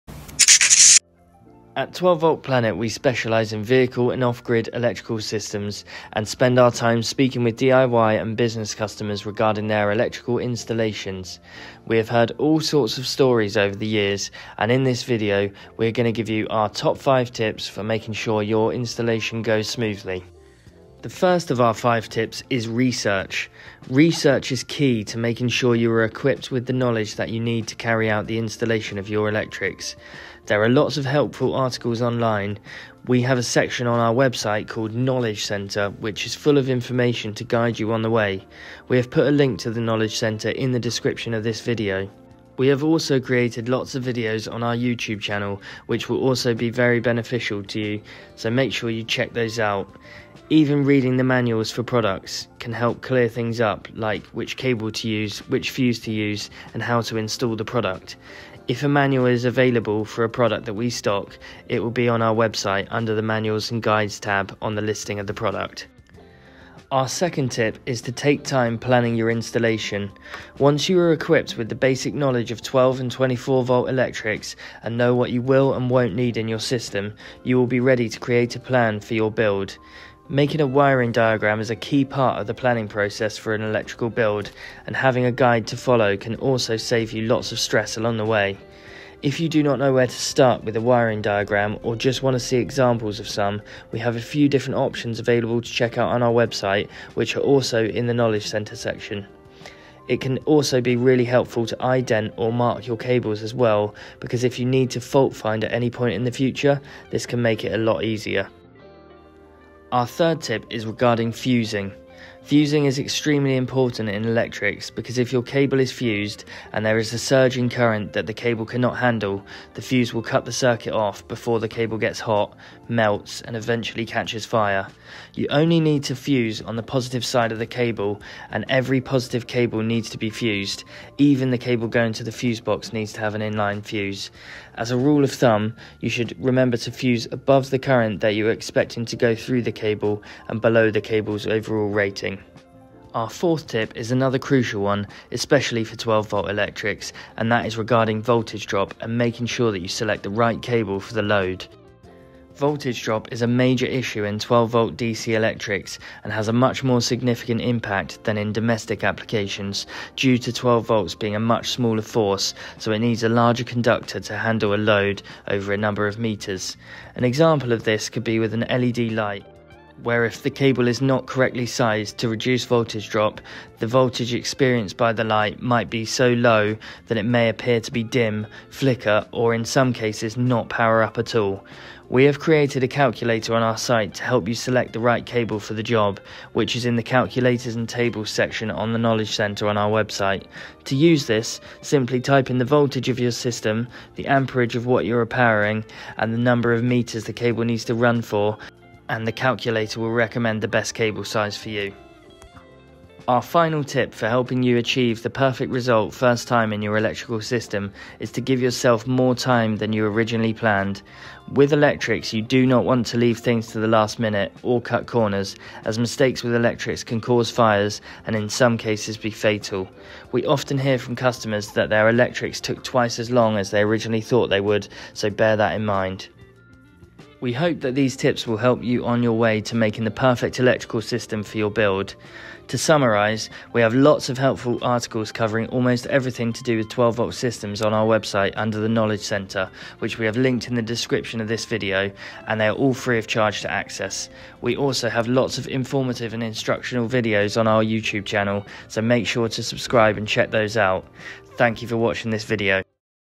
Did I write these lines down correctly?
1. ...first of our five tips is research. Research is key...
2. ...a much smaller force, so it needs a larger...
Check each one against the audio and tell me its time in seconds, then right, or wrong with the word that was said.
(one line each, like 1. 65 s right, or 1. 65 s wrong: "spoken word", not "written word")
1. 21 s right
2. 161 s right.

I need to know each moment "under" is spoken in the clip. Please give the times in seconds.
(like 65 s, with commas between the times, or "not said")
62 s, 238 s.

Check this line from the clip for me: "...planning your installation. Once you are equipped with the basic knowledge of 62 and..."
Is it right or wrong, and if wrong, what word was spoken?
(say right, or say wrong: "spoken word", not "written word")
wrong: "12", not "62".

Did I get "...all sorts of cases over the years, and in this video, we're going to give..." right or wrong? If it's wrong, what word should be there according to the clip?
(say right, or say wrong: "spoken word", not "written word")
wrong: "stories", not "cases".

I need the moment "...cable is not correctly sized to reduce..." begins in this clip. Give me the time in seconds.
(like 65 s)
170 s.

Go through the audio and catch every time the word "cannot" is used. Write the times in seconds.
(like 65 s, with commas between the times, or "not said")
118 s.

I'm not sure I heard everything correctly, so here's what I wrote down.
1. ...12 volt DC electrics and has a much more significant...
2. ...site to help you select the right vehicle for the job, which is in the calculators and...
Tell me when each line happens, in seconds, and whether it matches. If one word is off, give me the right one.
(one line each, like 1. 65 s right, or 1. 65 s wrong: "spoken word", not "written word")
1. 154 s right
2. 183 s wrong: "cable", not "vehicle".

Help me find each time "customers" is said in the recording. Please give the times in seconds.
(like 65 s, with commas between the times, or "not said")
8 s, 221 s.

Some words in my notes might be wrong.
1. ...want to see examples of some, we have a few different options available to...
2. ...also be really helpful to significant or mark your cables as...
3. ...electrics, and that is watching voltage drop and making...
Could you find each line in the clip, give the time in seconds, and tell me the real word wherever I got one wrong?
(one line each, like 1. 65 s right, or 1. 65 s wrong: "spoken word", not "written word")
1. 92 s right
2. 100 s wrong: "ident", not "significant"
3. 146 s wrong: "regarding", not "watching".